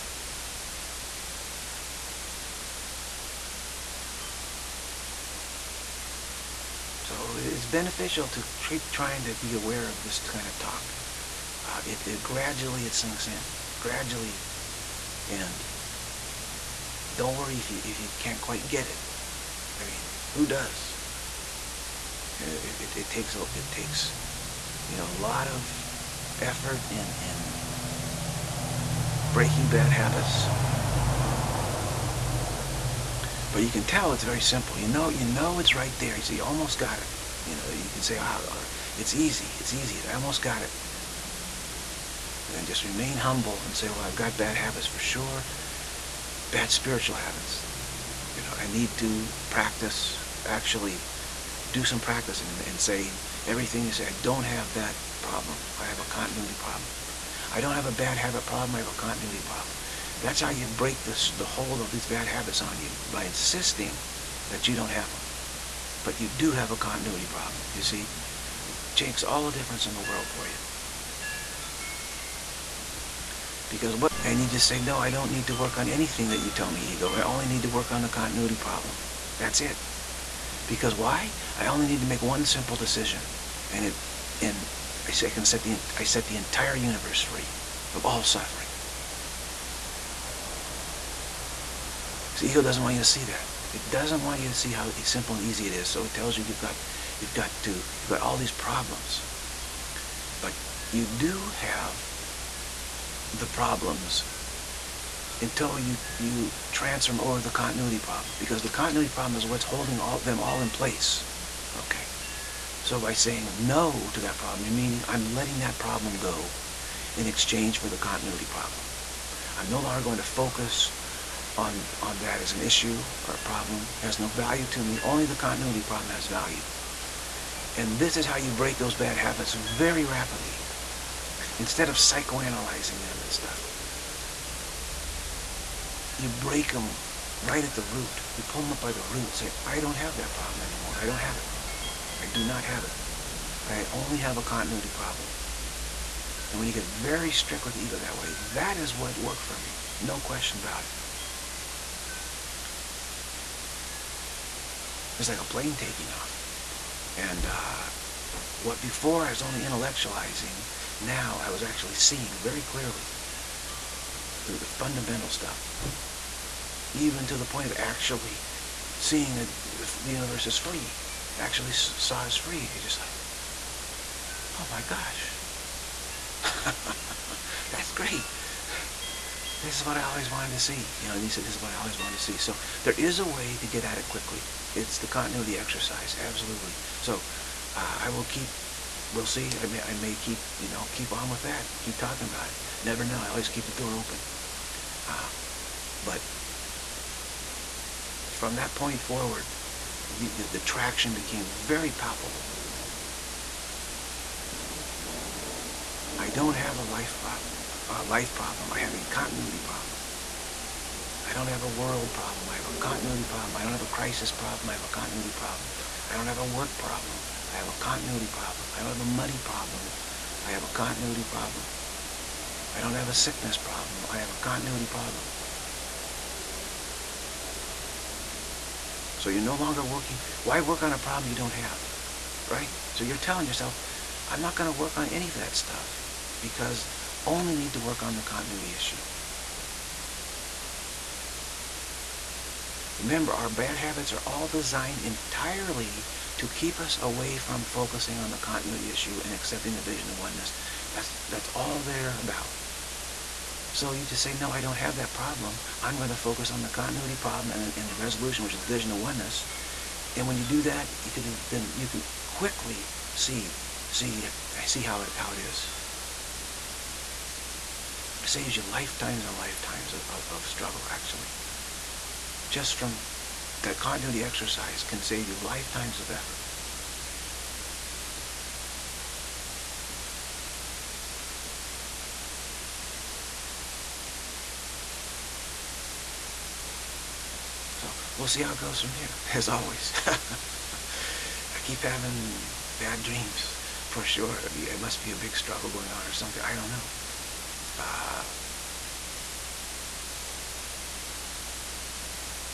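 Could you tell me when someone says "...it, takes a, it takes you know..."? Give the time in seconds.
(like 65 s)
22 s.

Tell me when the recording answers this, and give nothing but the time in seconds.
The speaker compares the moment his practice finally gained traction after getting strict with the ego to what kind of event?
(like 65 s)
155 s.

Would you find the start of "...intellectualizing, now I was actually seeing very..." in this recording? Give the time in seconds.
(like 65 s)
159 s.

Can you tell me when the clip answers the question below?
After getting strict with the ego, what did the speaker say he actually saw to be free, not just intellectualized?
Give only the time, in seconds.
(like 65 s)
170 s.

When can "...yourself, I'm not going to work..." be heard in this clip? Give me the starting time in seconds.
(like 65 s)
233 s.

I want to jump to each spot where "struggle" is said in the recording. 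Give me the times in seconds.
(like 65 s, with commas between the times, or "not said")
270 s, 295 s.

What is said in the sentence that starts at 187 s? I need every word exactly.
So uh, I will keep, we'll see.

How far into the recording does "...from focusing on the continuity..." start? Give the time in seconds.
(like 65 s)
247 s.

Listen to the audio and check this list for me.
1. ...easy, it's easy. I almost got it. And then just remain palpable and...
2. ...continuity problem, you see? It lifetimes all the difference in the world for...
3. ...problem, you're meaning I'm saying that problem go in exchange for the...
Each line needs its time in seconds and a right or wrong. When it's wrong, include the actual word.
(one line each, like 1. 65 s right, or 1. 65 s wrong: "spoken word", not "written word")
1. 39 s wrong: "humble", not "palpable"
2. 66 s wrong: "makes", not "lifetimes"
3. 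114 s wrong: "letting", not "saying".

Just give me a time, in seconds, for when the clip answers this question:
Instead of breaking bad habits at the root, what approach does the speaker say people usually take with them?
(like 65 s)
131 s.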